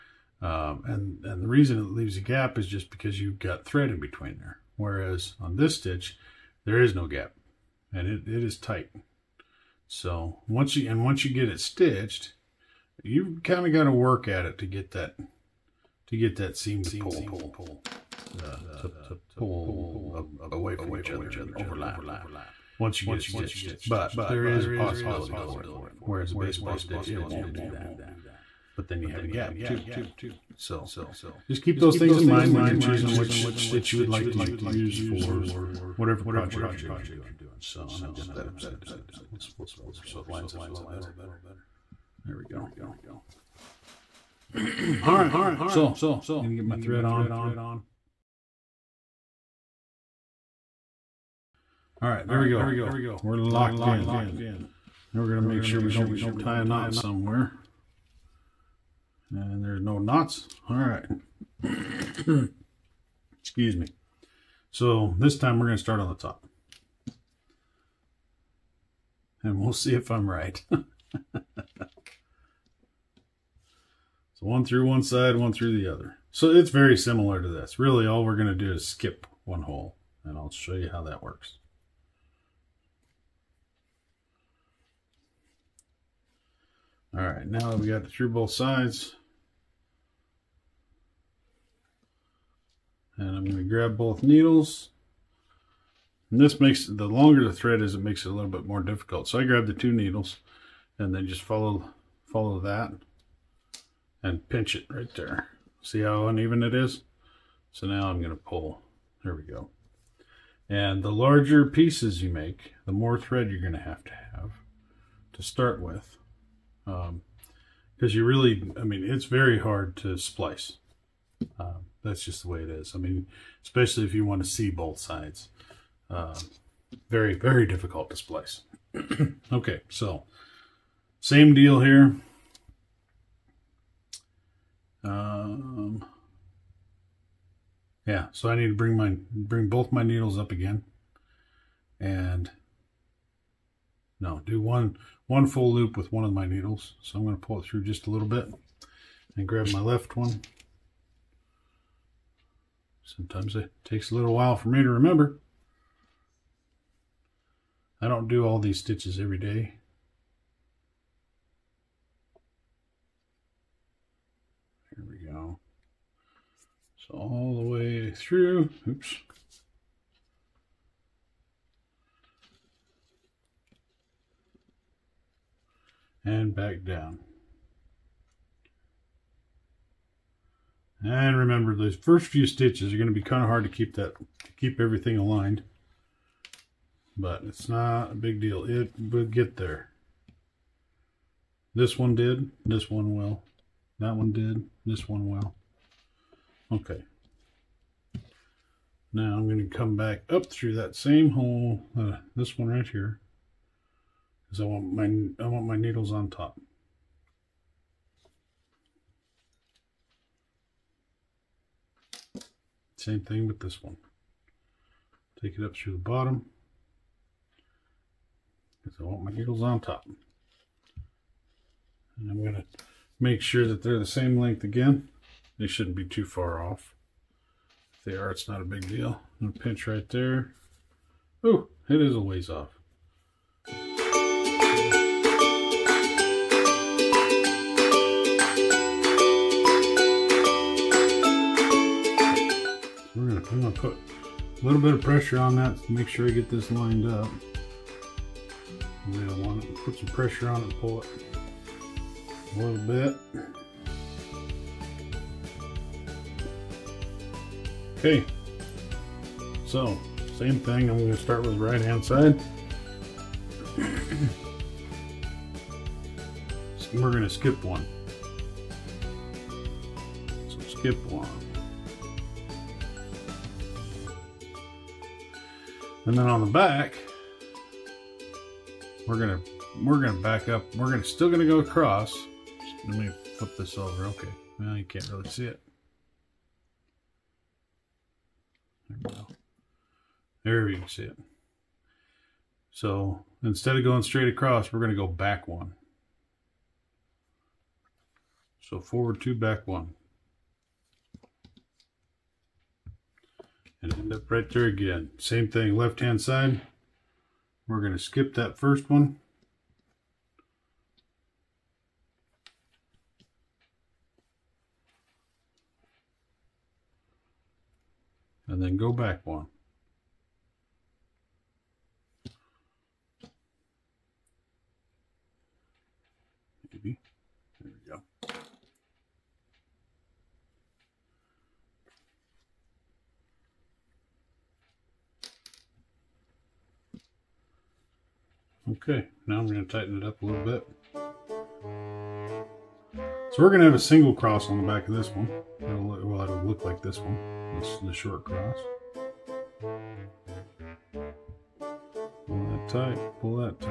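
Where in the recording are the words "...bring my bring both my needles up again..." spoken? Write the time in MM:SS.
02:18.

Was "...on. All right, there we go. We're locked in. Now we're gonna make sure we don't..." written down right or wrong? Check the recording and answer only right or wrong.
right.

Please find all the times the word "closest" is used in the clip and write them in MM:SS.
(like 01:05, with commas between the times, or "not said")
not said.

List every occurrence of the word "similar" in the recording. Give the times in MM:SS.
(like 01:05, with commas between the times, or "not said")
01:16.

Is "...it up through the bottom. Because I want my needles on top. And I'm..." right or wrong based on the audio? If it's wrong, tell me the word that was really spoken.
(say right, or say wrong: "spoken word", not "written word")
right.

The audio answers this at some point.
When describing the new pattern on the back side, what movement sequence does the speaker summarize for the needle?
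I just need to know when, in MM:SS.
04:58.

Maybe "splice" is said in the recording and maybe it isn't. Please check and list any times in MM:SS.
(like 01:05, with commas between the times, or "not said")
02:00, 02:08.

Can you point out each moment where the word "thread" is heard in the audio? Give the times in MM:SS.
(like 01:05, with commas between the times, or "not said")
00:03, 00:46, 01:37, 01:53.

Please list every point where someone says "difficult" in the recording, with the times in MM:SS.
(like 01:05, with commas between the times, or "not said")
01:38, 02:07.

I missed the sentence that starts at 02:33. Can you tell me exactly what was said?
Sometimes it takes a little while for me to remember.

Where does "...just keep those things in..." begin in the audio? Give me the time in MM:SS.
00:31.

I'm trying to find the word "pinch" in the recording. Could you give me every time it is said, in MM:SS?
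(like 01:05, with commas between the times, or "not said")
01:44, 03:49.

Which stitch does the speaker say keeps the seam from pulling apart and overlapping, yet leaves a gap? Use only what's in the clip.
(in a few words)
baseball stitch.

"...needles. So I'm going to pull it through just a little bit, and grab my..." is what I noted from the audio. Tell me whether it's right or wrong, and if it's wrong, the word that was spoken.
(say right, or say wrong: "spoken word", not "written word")
right.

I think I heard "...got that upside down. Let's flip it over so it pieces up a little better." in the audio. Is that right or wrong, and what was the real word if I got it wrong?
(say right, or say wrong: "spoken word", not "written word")
wrong: "lines", not "pieces".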